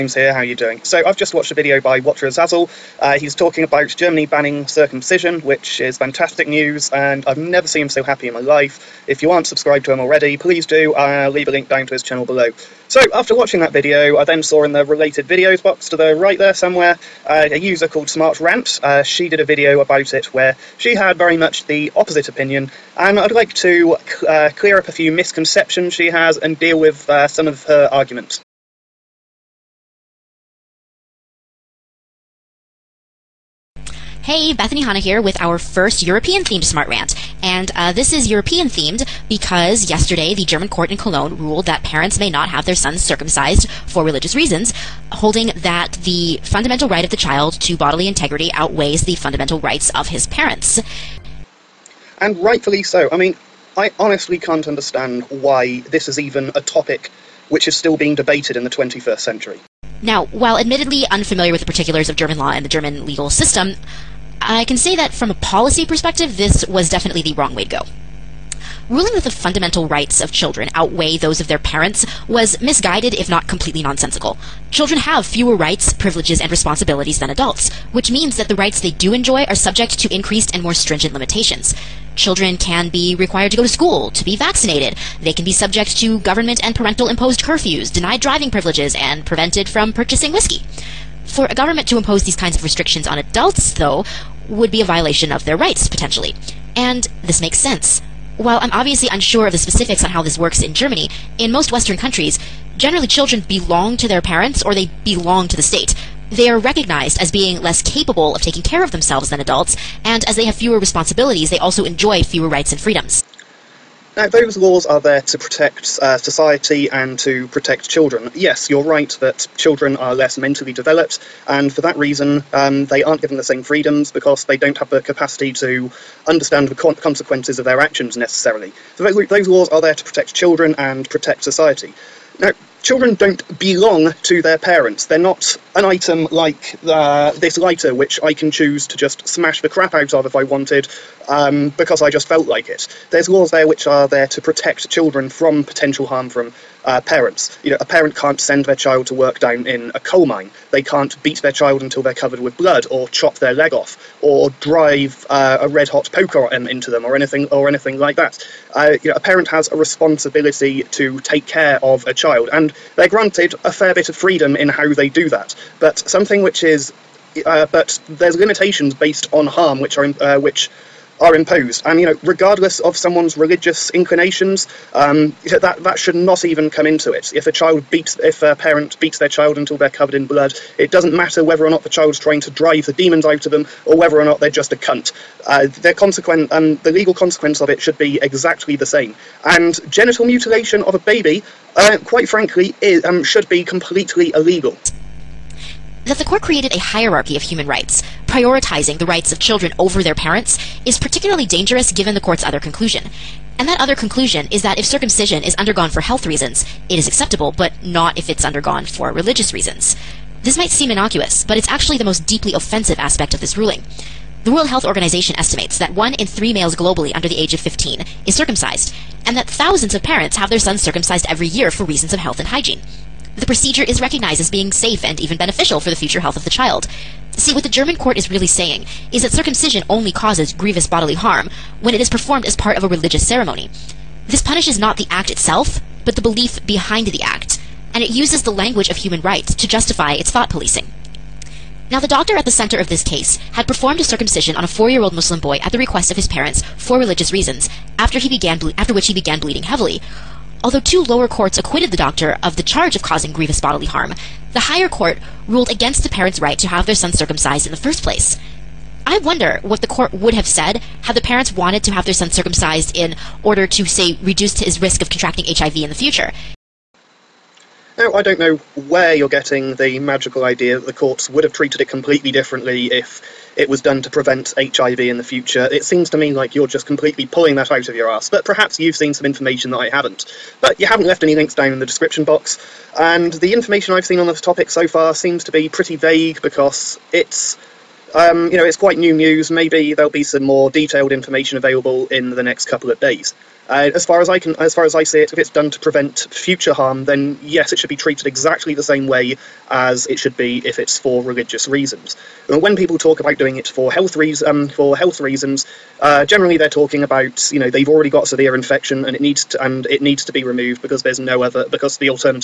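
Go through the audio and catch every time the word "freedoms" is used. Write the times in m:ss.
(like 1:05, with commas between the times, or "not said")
1:52, 2:03, 2:44.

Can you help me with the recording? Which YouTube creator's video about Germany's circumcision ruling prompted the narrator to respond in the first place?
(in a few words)
Watcher Azazel.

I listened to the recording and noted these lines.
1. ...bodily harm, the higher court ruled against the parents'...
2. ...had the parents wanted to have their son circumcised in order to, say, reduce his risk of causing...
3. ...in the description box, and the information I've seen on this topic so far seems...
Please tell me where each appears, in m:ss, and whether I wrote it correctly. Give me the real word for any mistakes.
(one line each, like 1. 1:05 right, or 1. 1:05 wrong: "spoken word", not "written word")
1. 4:13 right
2. 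4:21 wrong: "contracting", not "causing"
3. 4:41 right.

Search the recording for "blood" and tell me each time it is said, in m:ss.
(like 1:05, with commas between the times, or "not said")
2:32, 3:00.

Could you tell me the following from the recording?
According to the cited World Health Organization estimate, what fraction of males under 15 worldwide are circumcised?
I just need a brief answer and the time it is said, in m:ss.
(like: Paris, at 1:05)
one in three, at 3:35.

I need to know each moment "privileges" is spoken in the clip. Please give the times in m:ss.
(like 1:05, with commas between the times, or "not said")
1:15, 1:28.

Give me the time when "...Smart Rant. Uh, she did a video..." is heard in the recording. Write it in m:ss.
0:18.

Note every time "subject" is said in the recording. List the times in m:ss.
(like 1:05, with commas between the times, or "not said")
1:19, 1:25.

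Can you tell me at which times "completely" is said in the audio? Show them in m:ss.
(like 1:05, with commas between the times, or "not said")
1:13, 3:13, 4:31, 4:36.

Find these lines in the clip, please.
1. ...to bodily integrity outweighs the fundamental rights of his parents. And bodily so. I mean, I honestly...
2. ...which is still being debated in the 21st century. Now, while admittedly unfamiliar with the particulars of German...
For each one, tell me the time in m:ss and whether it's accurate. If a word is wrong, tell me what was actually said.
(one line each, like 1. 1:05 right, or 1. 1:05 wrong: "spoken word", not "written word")
1. 0:47 wrong: "rightfully", not "bodily"
2. 0:57 right.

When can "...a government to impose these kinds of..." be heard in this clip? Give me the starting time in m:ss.
1:31.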